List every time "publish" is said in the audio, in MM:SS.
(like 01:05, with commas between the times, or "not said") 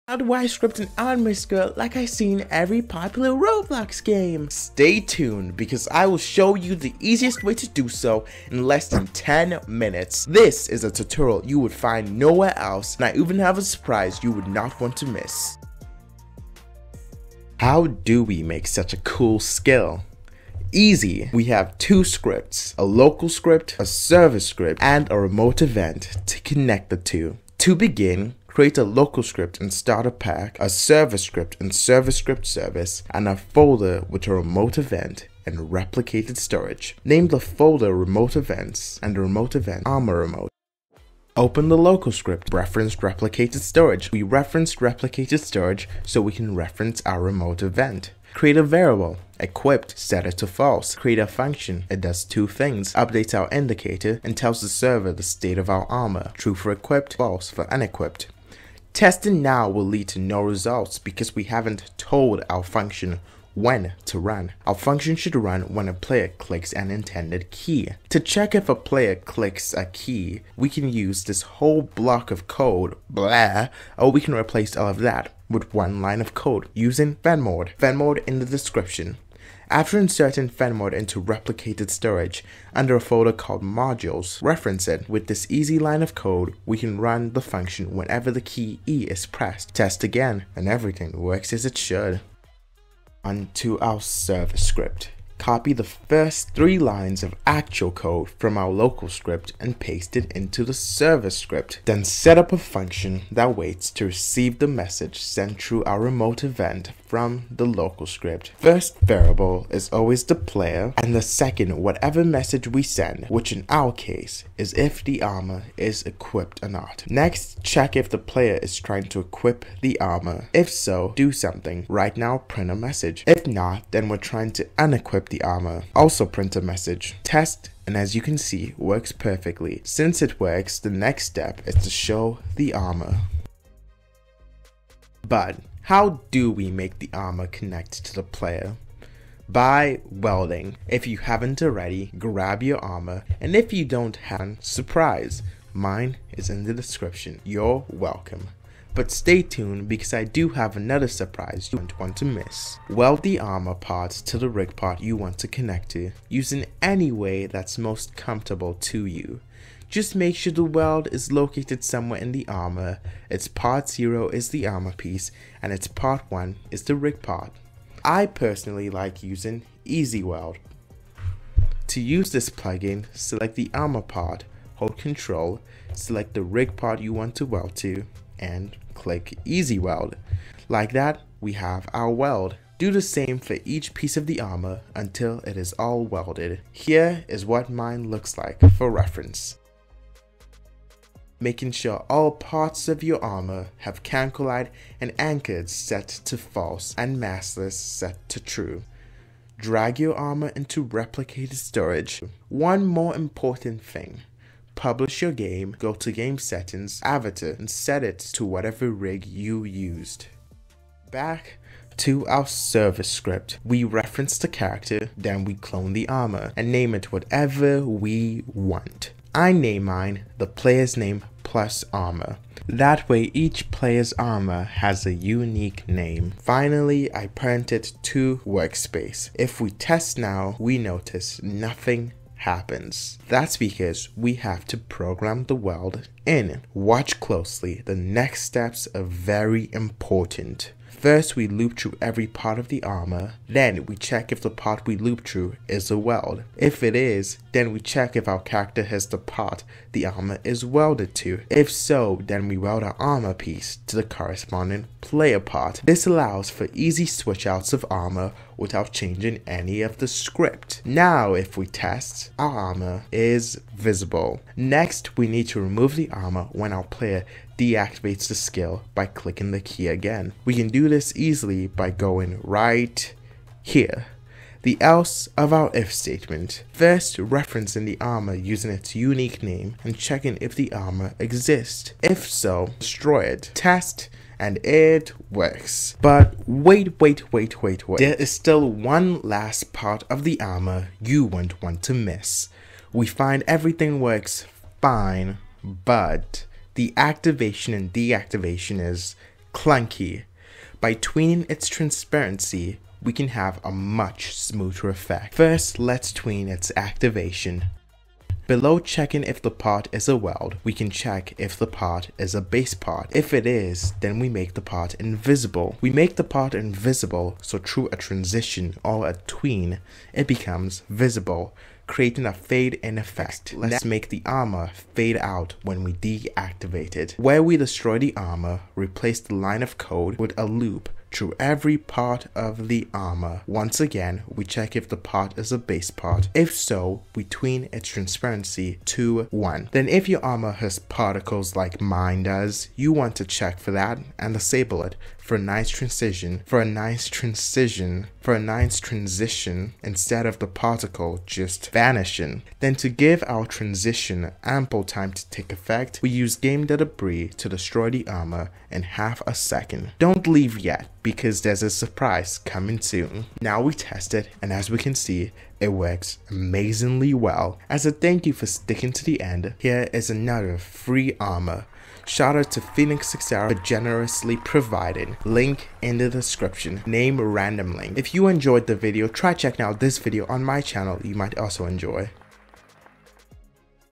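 03:24.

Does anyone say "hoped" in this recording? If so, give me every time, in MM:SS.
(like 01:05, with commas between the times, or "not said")
not said.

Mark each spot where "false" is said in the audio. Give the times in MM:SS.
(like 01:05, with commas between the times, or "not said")
00:50, 00:57, 03:16.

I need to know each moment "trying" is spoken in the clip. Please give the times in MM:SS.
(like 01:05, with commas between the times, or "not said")
01:58, 02:04.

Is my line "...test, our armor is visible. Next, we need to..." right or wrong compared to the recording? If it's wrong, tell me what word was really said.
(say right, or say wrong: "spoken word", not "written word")
right.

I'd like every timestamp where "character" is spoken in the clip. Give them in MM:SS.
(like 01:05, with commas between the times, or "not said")
03:34, 04:08.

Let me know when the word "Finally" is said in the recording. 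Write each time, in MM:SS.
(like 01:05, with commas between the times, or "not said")
03:46.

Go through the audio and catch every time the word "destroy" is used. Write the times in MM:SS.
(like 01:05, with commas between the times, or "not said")
04:42, 05:27, 05:57.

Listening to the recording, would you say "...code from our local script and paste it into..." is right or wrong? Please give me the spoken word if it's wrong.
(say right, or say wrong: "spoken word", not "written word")
right.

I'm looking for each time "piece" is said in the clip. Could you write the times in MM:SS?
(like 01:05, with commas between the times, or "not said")
02:44, 03:03, 04:13.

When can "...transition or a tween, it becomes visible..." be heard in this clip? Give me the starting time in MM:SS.
05:17.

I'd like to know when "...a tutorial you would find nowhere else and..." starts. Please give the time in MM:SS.
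00:10.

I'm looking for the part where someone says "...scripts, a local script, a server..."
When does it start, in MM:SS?
00:22.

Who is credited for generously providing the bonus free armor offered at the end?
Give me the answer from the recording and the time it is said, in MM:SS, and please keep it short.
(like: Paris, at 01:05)
Phoenix Sixera, at 06:12.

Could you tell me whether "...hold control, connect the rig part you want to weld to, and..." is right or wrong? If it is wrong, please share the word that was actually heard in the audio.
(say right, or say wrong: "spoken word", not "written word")
wrong: "select", not "connect".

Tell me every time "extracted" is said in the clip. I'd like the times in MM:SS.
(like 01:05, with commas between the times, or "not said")
not said.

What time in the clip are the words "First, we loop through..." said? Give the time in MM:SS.
04:00.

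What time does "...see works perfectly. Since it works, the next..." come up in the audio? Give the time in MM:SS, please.
02:08.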